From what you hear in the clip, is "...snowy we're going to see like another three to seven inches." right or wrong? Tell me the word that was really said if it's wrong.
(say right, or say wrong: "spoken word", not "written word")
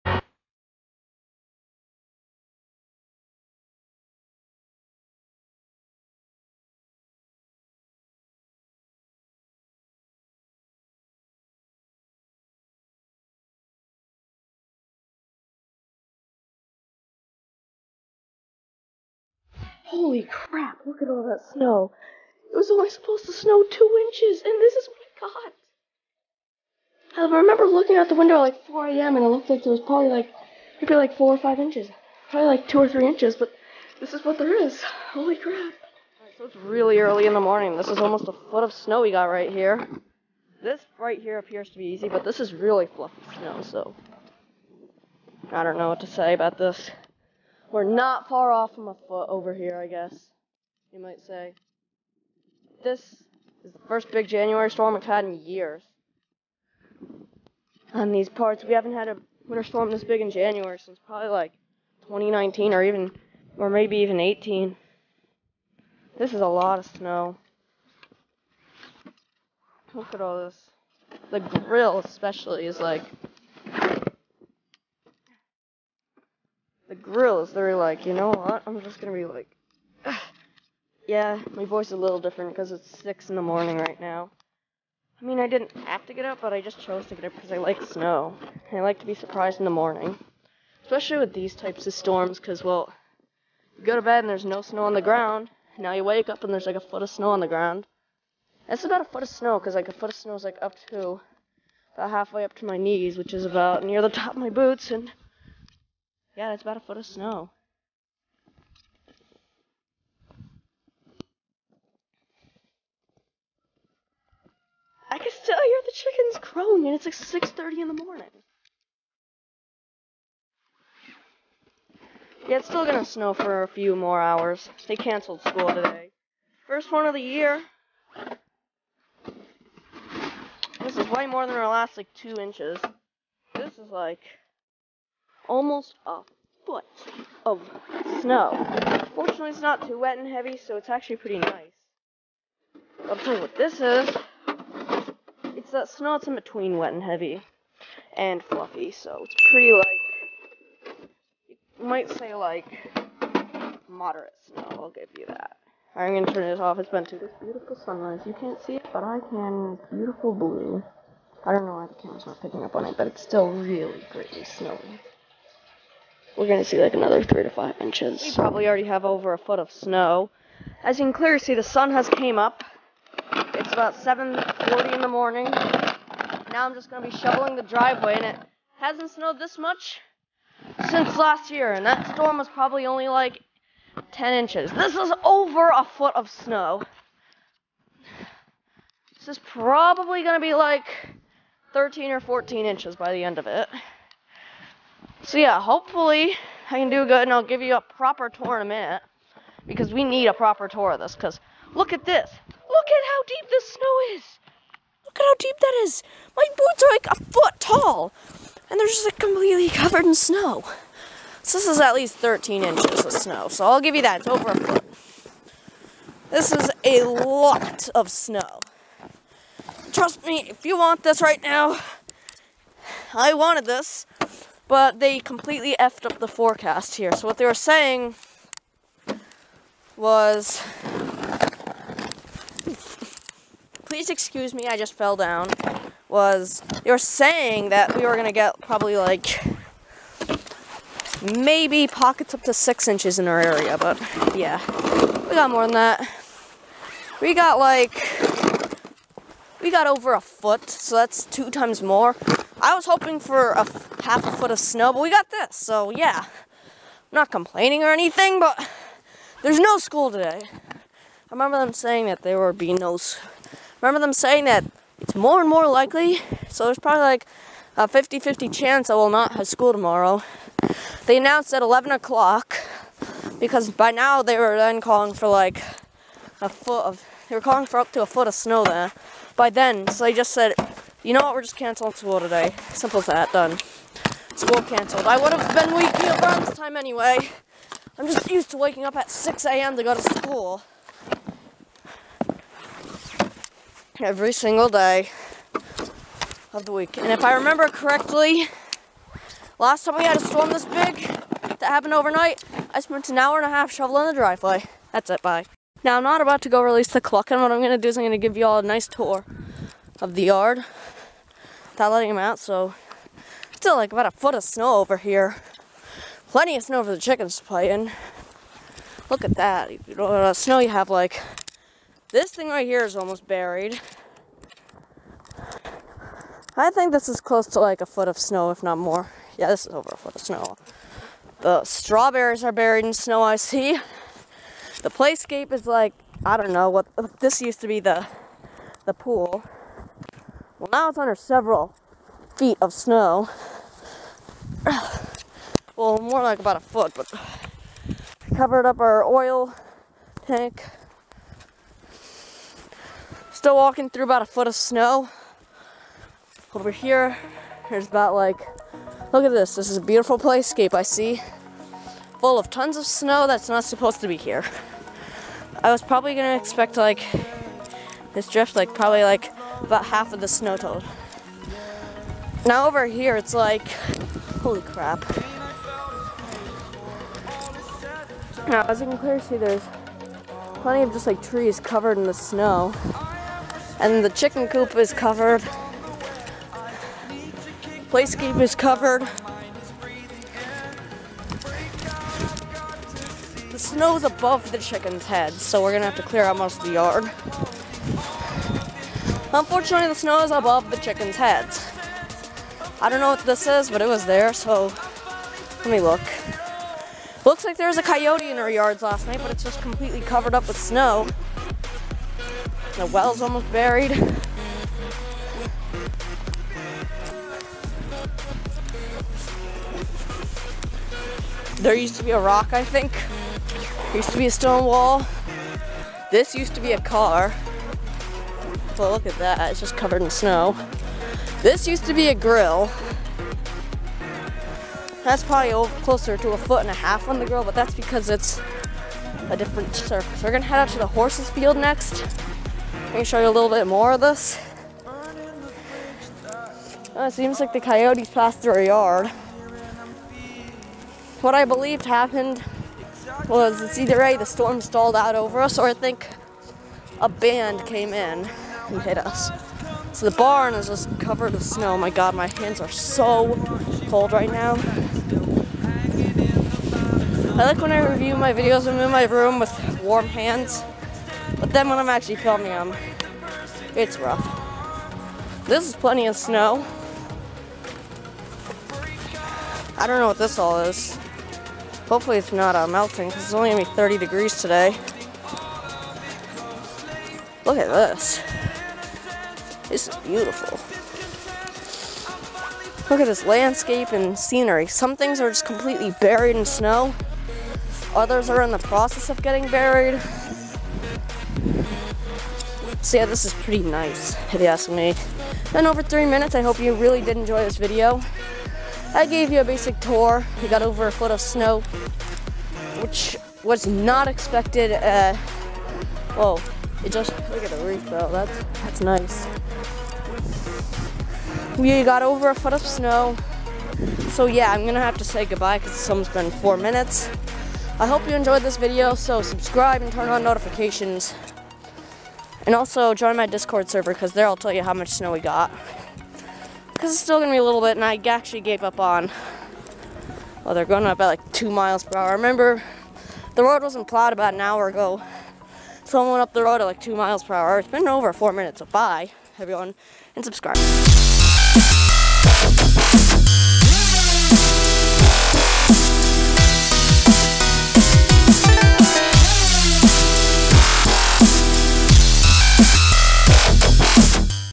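wrong: "five", not "seven".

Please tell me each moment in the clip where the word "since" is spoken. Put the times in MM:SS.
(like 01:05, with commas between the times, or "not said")
01:00, 03:00.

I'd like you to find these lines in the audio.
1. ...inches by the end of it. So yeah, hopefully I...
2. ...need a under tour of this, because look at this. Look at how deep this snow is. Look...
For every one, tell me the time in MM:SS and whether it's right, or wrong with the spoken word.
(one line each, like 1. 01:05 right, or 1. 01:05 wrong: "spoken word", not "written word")
1. 03:12 right
2. 03:20 wrong: "proper", not "under".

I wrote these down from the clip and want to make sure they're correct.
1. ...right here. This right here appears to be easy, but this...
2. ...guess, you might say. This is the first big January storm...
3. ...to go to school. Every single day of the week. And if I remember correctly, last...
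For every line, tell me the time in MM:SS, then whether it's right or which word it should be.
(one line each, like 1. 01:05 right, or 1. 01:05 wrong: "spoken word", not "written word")
1. 00:39 right
2. 00:49 right
3. 04:49 right.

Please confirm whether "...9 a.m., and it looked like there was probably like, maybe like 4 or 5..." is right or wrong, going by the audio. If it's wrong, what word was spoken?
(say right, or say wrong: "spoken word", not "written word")
wrong: "4", not "9".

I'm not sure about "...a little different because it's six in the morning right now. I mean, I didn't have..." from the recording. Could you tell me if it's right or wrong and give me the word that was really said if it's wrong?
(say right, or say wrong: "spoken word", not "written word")
right.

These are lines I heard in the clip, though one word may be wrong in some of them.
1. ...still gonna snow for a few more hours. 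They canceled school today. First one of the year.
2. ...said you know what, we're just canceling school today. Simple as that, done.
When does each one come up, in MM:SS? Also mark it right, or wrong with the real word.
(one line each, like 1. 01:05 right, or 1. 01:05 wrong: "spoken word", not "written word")
1. 02:02 right
2. 04:40 right.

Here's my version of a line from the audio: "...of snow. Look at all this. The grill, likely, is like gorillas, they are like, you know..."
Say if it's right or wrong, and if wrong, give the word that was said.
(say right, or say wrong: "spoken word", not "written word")
wrong: "especially", not "likely".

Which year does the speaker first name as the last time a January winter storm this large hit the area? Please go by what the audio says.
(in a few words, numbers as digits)
2019.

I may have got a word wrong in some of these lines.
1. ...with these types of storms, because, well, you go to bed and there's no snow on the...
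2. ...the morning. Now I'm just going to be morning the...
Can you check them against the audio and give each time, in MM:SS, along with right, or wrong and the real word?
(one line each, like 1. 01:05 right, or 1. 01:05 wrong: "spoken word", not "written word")
1. 01:31 right
2. 02:55 wrong: "shoveling", not "morning".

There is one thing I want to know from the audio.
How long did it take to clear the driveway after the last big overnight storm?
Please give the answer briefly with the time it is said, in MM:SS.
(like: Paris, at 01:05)
an hour and a half, at 05:03.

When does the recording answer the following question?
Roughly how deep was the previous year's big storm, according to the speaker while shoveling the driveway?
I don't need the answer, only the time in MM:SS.
03:04.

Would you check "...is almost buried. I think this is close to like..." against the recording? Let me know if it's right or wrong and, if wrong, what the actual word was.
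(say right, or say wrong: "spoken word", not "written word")
right.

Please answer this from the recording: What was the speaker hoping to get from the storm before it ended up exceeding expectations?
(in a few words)
half a foot.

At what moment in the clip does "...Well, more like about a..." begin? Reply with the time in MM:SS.
05:45.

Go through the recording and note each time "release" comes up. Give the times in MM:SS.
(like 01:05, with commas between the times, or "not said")
05:06.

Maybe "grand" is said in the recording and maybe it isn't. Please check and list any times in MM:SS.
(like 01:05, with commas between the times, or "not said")
not said.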